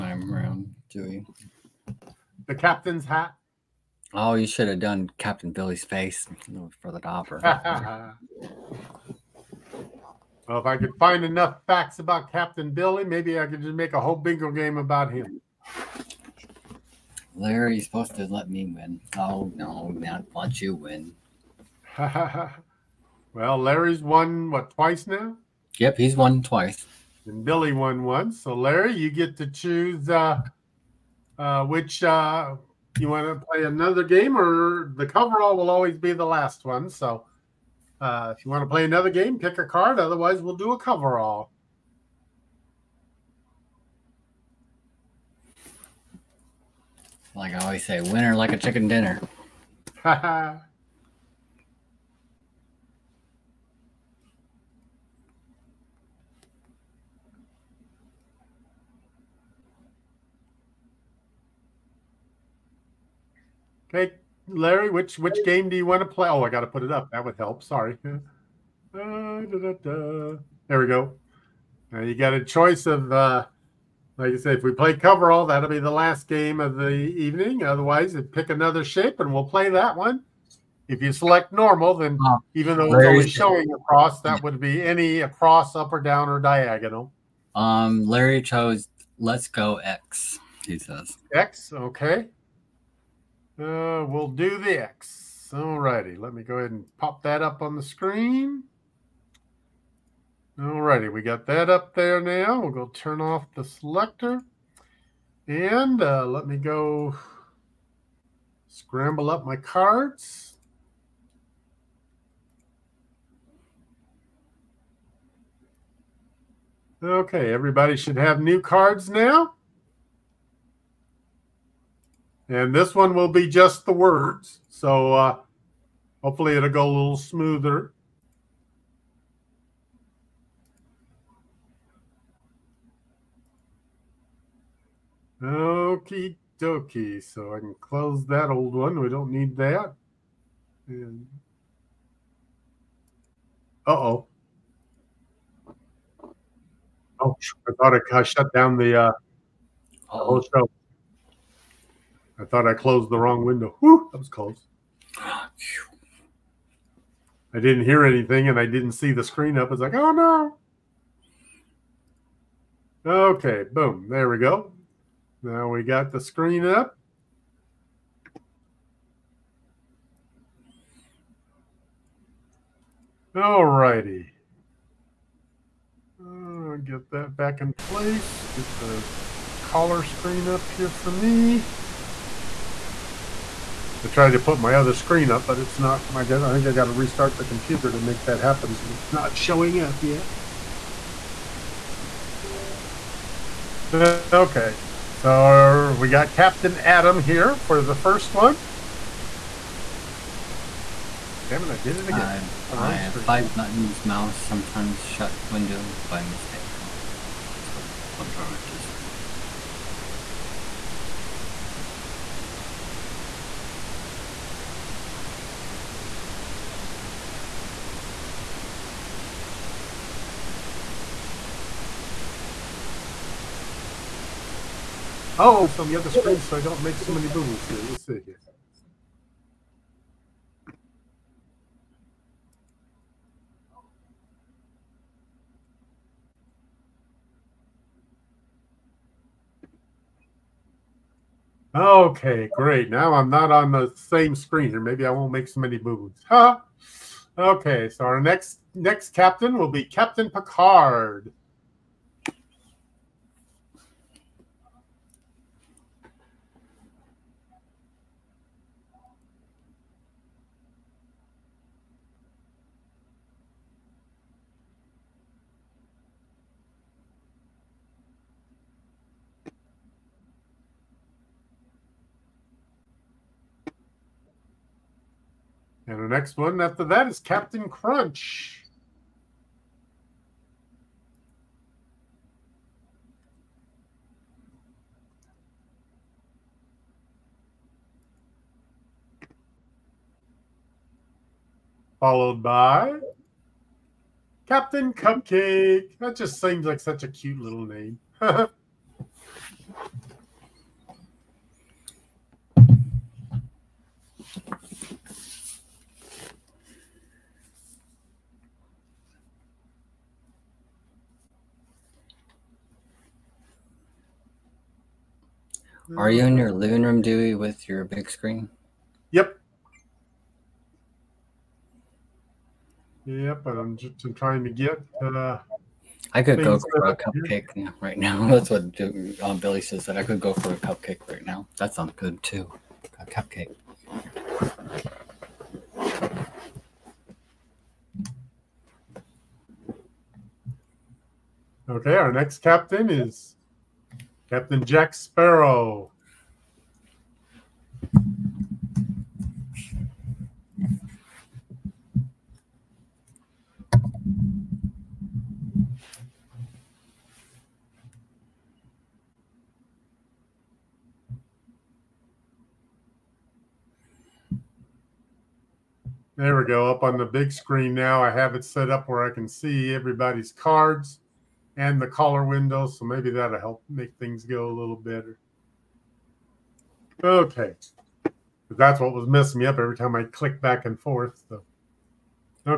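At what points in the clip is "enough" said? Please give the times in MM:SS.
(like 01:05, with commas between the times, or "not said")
00:11.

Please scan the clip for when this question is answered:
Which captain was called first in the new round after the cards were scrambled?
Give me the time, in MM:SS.
03:16.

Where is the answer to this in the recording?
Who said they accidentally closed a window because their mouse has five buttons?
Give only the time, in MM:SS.
03:28.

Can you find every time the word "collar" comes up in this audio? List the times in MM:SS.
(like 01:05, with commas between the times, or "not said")
02:59, 06:11.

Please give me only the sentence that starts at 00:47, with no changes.
Like I always say, winner like a chicken dinner.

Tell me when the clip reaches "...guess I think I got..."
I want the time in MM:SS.
03:06.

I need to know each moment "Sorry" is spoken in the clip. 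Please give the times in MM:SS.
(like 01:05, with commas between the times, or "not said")
01:07.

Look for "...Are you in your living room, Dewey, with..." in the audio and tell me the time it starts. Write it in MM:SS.
05:15.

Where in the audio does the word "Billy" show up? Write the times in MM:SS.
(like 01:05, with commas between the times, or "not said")
00:05, 00:12, 00:27, 05:29.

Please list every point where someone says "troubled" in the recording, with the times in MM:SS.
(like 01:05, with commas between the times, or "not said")
not said.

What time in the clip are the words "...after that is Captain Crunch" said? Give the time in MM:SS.
04:36.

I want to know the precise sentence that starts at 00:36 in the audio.
So uh, if you want to play another game, pick a card.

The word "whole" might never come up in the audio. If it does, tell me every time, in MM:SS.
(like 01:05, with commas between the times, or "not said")
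00:14, 02:30.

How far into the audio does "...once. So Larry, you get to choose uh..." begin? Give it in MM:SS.
00:28.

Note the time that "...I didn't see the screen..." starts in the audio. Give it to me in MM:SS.
02:38.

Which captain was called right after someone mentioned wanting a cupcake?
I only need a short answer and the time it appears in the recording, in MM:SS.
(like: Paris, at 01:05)
Captain Jack Sparrow, at 05:44.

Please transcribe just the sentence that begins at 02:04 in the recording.
So uh, hopefully it'll go a little smoother.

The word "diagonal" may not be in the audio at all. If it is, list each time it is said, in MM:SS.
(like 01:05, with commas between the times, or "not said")
01:26.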